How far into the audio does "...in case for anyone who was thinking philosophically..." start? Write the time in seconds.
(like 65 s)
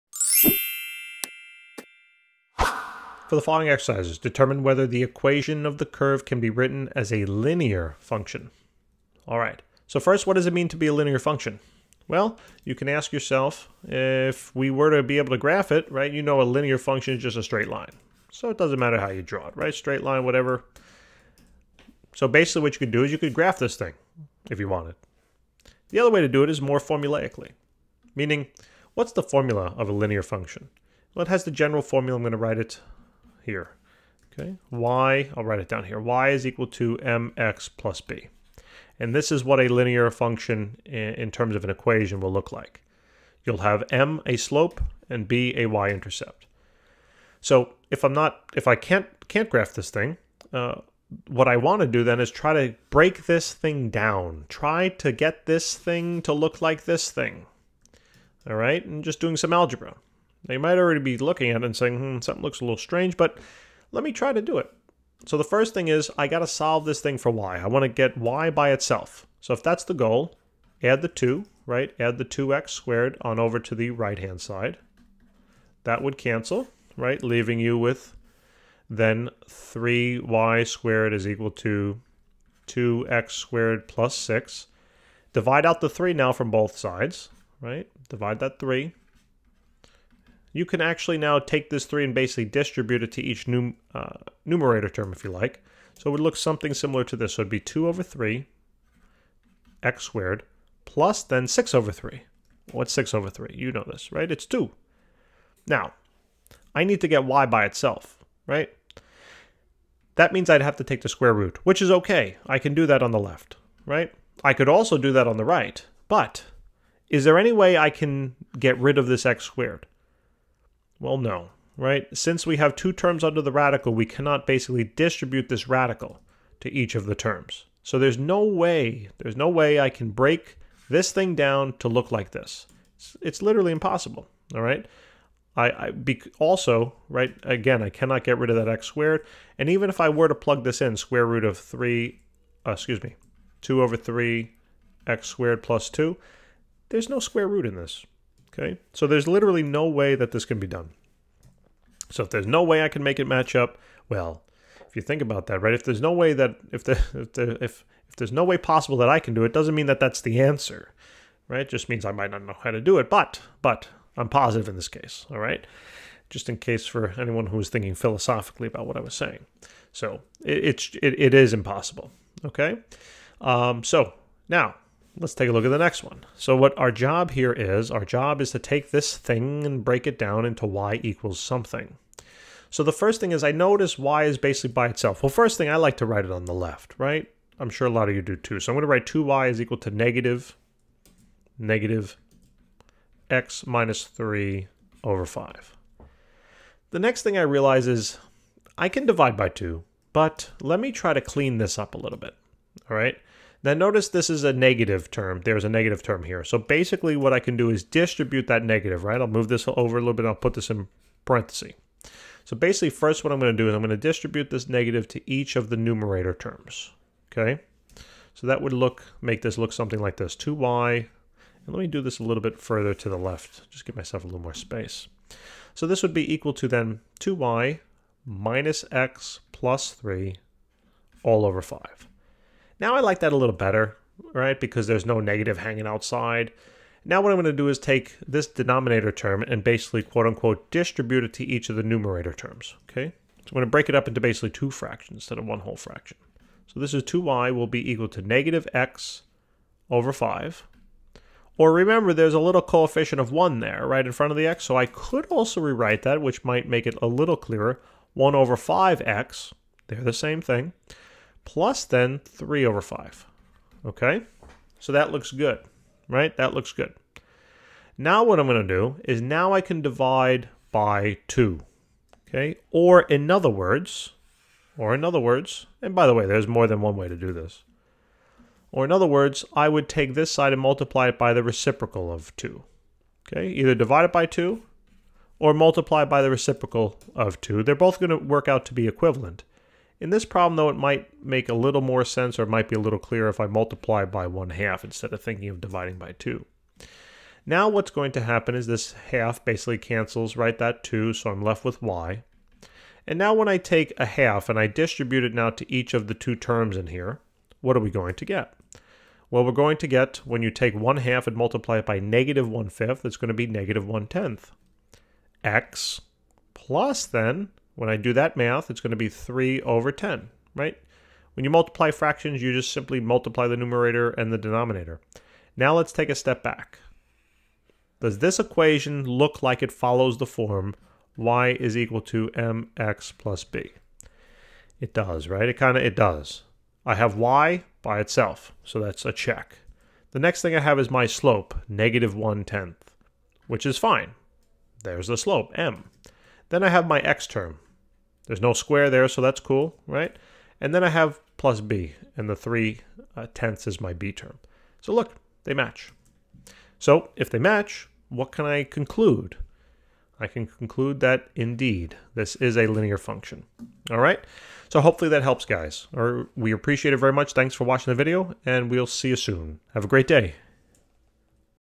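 166 s.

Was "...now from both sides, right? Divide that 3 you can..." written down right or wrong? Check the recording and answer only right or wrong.
right.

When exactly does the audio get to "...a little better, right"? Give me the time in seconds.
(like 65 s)
233 s.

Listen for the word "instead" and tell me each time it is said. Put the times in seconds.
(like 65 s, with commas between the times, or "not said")
245 s, 294 s.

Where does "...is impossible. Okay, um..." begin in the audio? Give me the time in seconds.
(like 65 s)
171 s.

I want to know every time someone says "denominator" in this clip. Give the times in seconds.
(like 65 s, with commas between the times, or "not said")
238 s, 324 s.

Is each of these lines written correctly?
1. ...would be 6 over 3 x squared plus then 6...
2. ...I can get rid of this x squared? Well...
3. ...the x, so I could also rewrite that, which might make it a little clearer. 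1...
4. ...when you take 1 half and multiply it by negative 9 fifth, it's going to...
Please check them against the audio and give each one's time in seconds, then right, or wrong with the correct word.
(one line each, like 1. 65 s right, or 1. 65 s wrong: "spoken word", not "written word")
1. 97 s wrong: "2", not "6"
2. 117 s right
3. 254 s right
4. 310 s wrong: "1", not "9".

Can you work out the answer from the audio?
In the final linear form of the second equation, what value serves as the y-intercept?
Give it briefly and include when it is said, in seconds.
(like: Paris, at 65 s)
3/10, at 352 s.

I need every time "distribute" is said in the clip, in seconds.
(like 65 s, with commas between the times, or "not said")
92 s, 124 s, 207 s, 213 s, 240 s, 304 s.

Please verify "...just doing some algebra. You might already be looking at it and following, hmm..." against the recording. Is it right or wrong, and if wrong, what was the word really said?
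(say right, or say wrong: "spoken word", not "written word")
wrong: "saying", not "following".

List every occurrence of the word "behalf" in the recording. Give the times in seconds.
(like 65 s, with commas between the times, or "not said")
not said.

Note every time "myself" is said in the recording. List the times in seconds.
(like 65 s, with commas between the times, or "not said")
223 s.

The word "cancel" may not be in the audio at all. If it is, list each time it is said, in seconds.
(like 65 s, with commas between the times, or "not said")
76 s, 299 s.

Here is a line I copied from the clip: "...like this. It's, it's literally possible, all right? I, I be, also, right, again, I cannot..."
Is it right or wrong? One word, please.
wrong.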